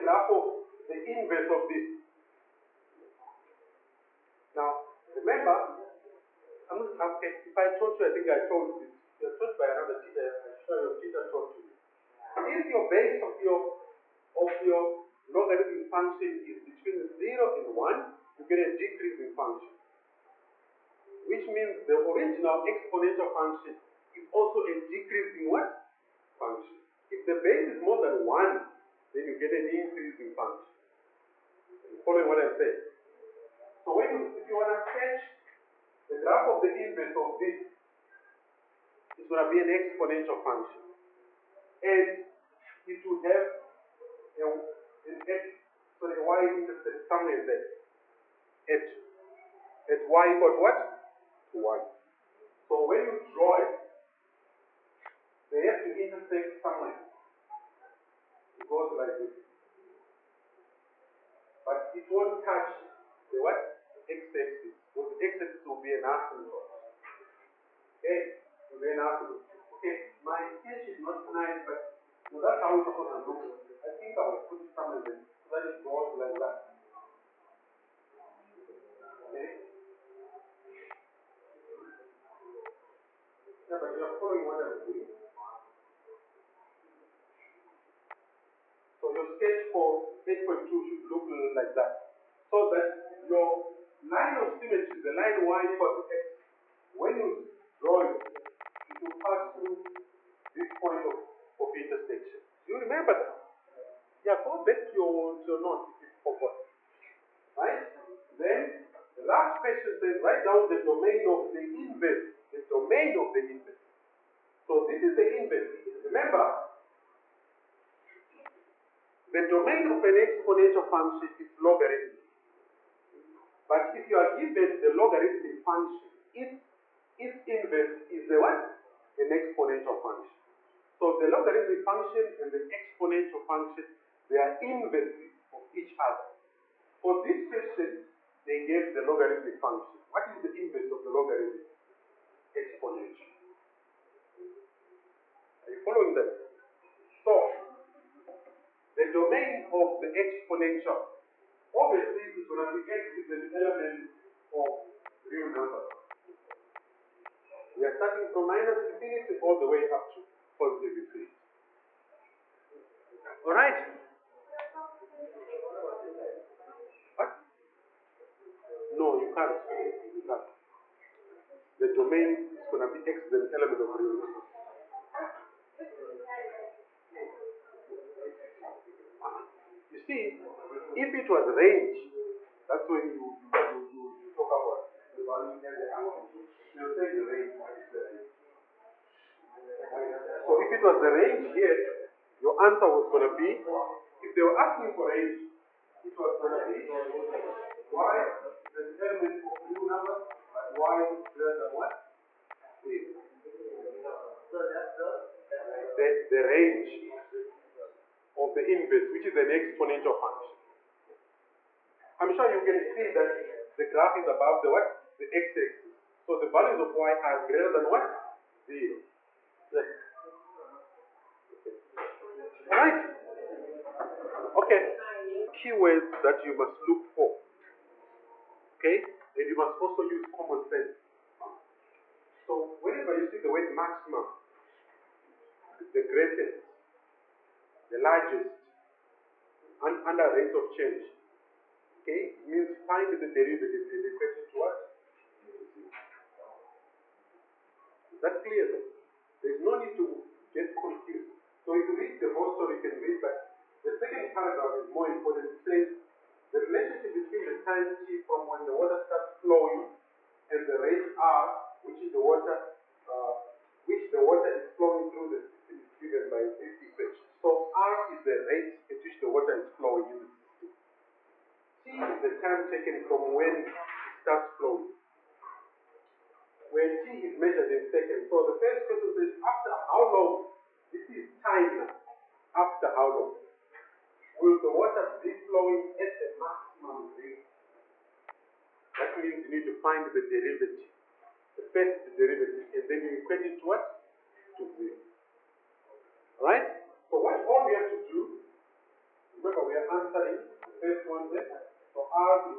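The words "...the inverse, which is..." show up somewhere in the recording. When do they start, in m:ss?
3:28.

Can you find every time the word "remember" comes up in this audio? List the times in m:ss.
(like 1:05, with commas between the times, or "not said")
0:05, 1:42, 1:56, 4:59.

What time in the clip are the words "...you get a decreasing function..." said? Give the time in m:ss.
0:18.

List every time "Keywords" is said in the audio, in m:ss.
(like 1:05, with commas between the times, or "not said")
3:45.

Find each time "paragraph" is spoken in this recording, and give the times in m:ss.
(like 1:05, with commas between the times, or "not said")
4:14.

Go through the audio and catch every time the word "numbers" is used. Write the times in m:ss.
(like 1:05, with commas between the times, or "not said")
2:35, 2:54, 3:19.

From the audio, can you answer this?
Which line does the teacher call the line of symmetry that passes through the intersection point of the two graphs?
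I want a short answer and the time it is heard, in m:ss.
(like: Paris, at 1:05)
y equal to x, at 1:35.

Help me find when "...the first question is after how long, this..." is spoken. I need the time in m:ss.
4:38.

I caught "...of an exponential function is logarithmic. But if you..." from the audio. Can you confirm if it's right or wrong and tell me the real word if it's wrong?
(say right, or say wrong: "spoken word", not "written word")
right.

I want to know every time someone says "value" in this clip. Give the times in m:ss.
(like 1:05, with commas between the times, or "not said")
3:05, 3:36.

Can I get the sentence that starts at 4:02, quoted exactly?
Okay, means find the derivative and equate it to what?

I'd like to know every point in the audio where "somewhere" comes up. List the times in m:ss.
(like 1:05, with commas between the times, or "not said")
0:47, 0:56, 1:14.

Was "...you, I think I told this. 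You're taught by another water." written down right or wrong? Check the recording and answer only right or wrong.
wrong.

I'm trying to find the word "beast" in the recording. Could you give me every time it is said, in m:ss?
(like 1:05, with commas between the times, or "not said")
not said.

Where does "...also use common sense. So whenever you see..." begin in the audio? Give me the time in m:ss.
3:49.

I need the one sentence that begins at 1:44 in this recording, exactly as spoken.
Yeah, go back to your, to your note if you forgot.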